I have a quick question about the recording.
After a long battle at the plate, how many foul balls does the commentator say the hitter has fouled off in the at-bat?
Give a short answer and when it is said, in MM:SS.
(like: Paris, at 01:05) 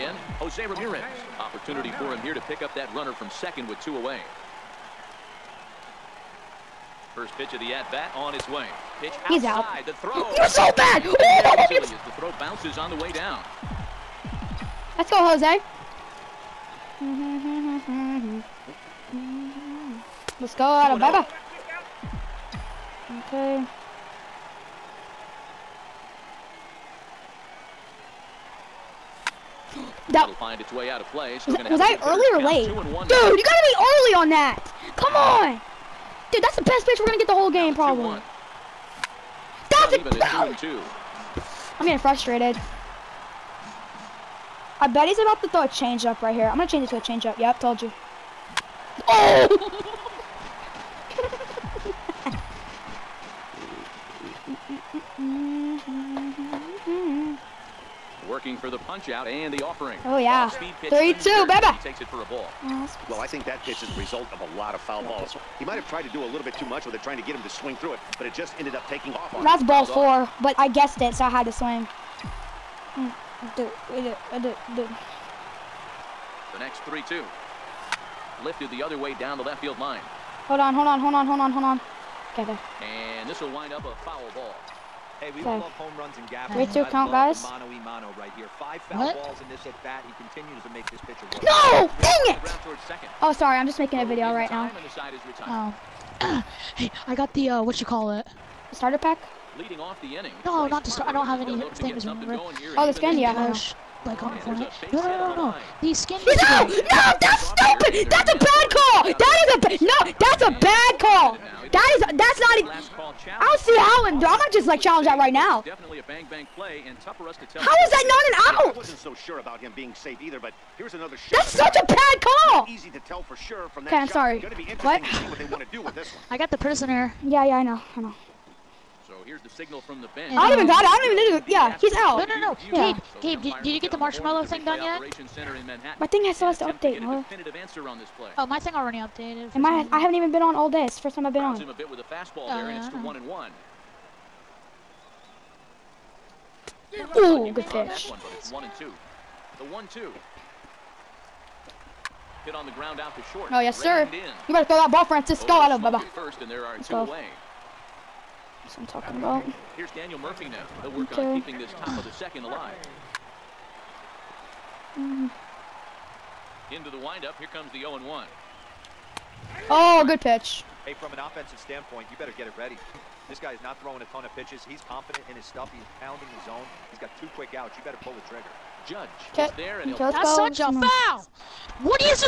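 5, at 01:28.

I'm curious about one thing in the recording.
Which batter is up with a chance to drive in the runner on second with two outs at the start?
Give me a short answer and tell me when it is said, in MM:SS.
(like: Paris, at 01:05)
Jose Ramirez, at 00:00.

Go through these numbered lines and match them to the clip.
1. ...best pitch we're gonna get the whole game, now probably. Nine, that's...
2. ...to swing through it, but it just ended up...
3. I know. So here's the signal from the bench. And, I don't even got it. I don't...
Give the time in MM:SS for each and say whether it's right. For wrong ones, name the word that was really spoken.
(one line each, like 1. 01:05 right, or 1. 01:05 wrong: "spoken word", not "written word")
1. 00:36 wrong: "Two", not "Nine"
2. 01:07 right
3. 02:07 right.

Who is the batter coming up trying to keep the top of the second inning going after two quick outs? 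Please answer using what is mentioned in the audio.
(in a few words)
Daniel Murphy.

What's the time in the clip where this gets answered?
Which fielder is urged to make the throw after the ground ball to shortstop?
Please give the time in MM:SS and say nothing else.
02:35.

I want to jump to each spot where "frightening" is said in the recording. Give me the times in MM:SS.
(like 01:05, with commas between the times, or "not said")
not said.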